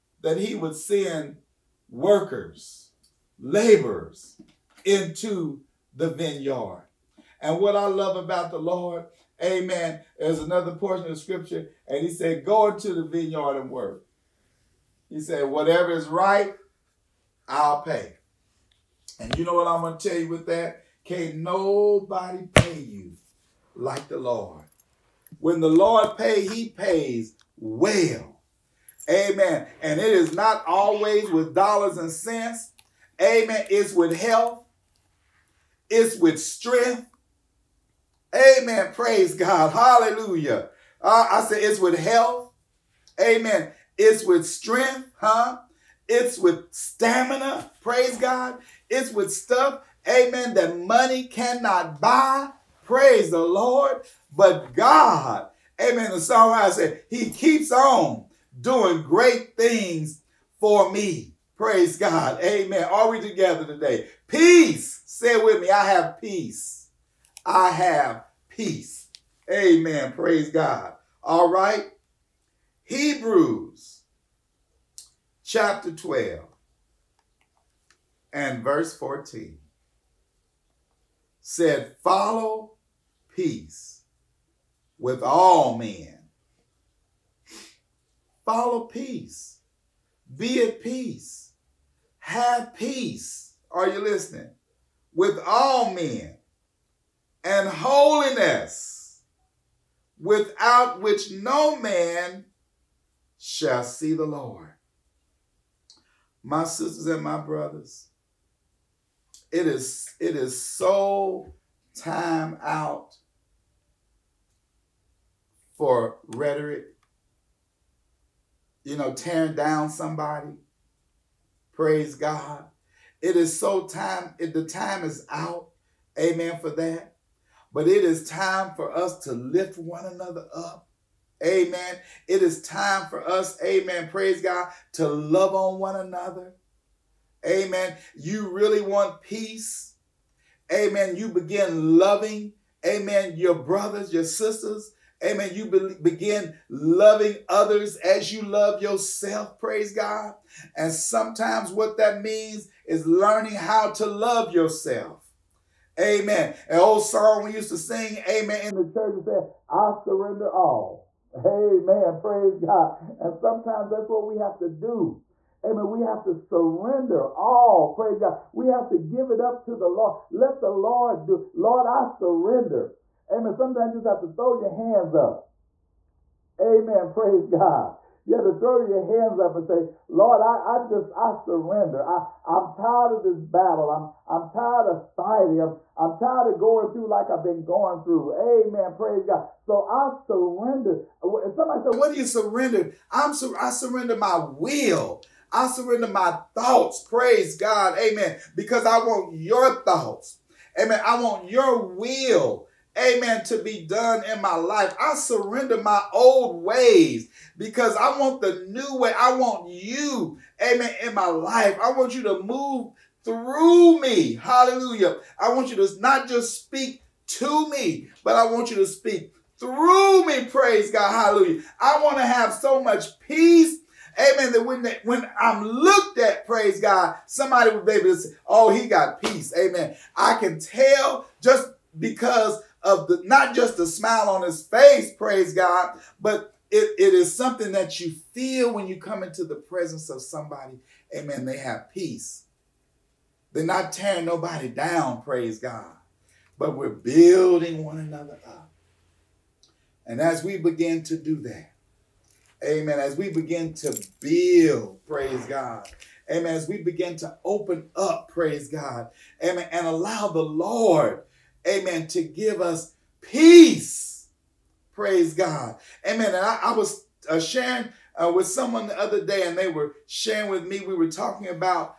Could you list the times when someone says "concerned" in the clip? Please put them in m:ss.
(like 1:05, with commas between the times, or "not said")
not said.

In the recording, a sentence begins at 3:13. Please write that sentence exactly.
I'm, sur- I surrender my will.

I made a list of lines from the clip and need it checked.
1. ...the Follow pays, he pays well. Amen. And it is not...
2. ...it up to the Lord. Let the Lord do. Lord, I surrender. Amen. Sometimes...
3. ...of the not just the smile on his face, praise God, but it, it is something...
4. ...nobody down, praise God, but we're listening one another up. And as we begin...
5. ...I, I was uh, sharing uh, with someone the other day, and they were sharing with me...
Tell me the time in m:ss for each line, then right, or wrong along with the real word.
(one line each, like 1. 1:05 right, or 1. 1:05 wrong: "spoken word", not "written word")
1. 0:25 wrong: "Lord", not "Follow"
2. 2:49 right
3. 3:52 right
4. 4:04 wrong: "building", not "listening"
5. 4:26 right.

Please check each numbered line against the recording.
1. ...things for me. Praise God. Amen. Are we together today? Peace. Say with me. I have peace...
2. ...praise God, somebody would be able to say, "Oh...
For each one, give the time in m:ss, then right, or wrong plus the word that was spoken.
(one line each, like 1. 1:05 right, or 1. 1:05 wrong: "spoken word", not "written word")
1. 0:59 right
2. 3:46 right.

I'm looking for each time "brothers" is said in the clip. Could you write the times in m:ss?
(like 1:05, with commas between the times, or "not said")
1:47, 2:23.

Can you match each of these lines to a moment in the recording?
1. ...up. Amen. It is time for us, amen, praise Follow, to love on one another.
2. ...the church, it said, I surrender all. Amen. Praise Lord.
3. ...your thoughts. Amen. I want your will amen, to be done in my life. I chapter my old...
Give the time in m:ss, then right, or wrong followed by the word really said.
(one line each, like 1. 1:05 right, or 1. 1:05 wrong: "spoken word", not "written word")
1. 2:10 wrong: "God", not "Follow"
2. 2:38 wrong: "God", not "Lord"
3. 3:19 wrong: "surrender", not "chapter".